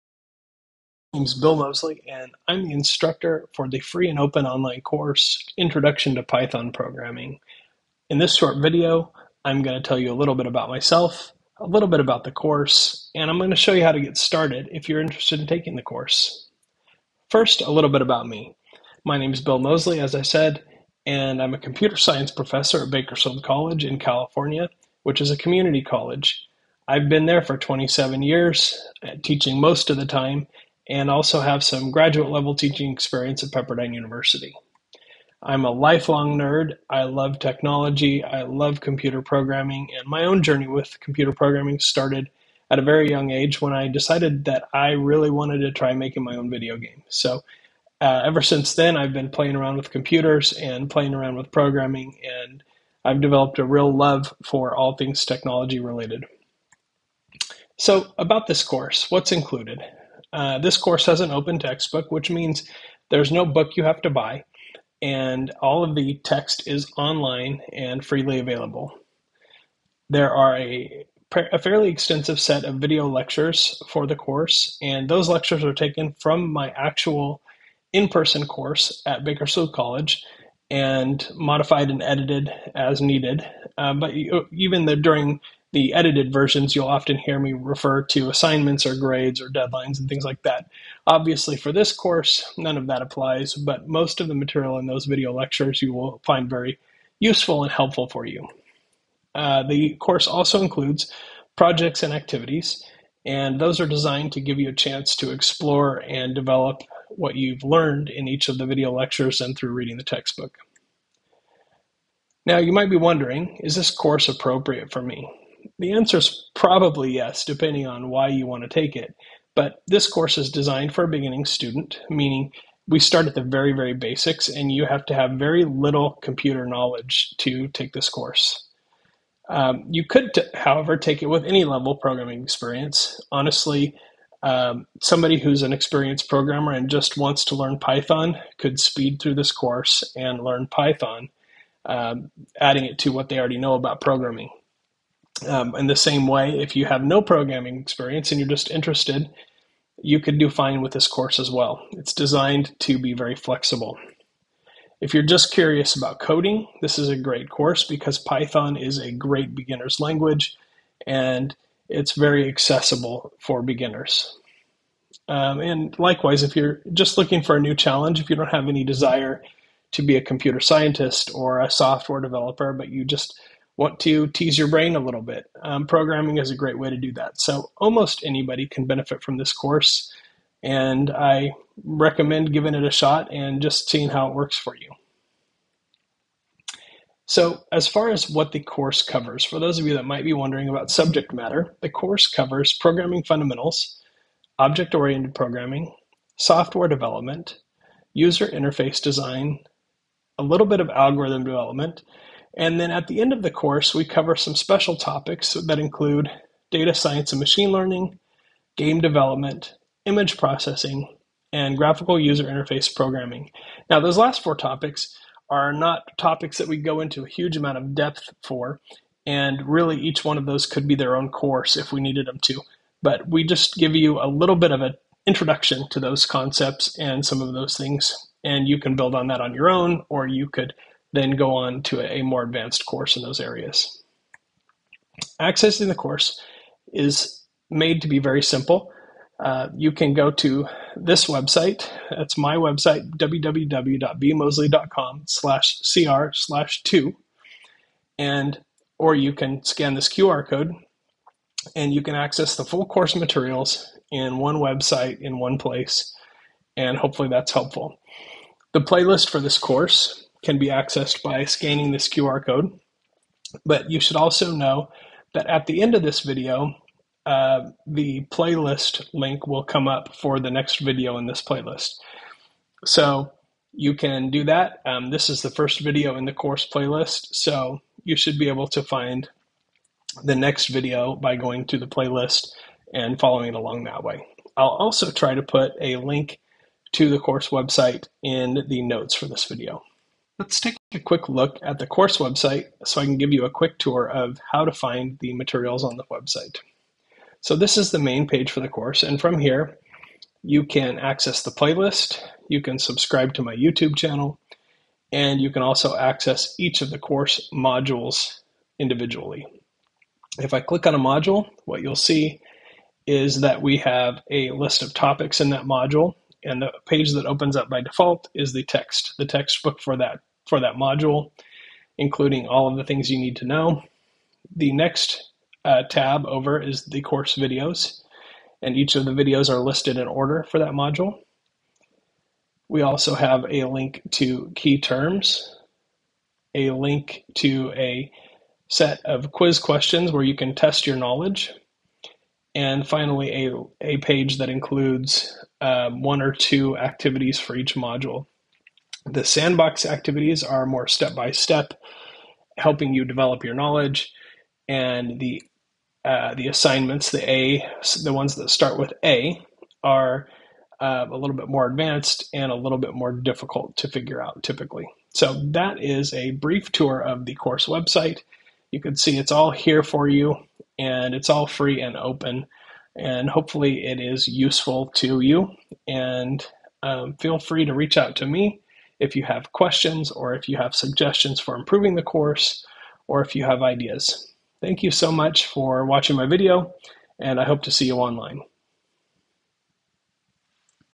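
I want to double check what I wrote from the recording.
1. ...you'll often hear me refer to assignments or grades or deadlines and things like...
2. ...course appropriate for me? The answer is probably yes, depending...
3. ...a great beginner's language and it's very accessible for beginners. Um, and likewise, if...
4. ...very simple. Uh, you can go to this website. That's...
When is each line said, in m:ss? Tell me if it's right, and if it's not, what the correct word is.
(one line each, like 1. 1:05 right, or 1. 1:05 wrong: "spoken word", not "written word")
1. 1:26 right
2. 1:53 right
3. 2:38 right
4. 3:58 right.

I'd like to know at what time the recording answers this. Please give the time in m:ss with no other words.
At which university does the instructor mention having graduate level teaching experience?
0:33.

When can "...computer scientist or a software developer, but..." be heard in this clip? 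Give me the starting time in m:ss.
2:50.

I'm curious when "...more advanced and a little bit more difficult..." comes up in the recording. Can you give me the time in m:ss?
6:01.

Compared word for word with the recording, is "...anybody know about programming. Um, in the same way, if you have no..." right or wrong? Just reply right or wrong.
wrong.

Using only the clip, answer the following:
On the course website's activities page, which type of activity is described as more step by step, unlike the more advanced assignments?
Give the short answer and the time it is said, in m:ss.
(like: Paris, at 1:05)
Sandbox activities, at 5:49.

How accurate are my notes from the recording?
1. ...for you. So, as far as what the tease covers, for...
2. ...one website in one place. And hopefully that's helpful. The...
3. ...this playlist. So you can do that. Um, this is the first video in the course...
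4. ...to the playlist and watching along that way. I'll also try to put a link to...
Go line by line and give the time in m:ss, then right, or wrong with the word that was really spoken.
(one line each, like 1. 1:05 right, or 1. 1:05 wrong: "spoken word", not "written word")
1. 3:04 wrong: "course", not "tease"
2. 4:14 right
3. 4:31 right
4. 4:41 wrong: "following", not "watching".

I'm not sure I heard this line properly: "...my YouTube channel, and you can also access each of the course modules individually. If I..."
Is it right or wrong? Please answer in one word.
right.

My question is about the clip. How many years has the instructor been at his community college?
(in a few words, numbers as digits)
27.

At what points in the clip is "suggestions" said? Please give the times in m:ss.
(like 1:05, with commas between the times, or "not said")
6:20.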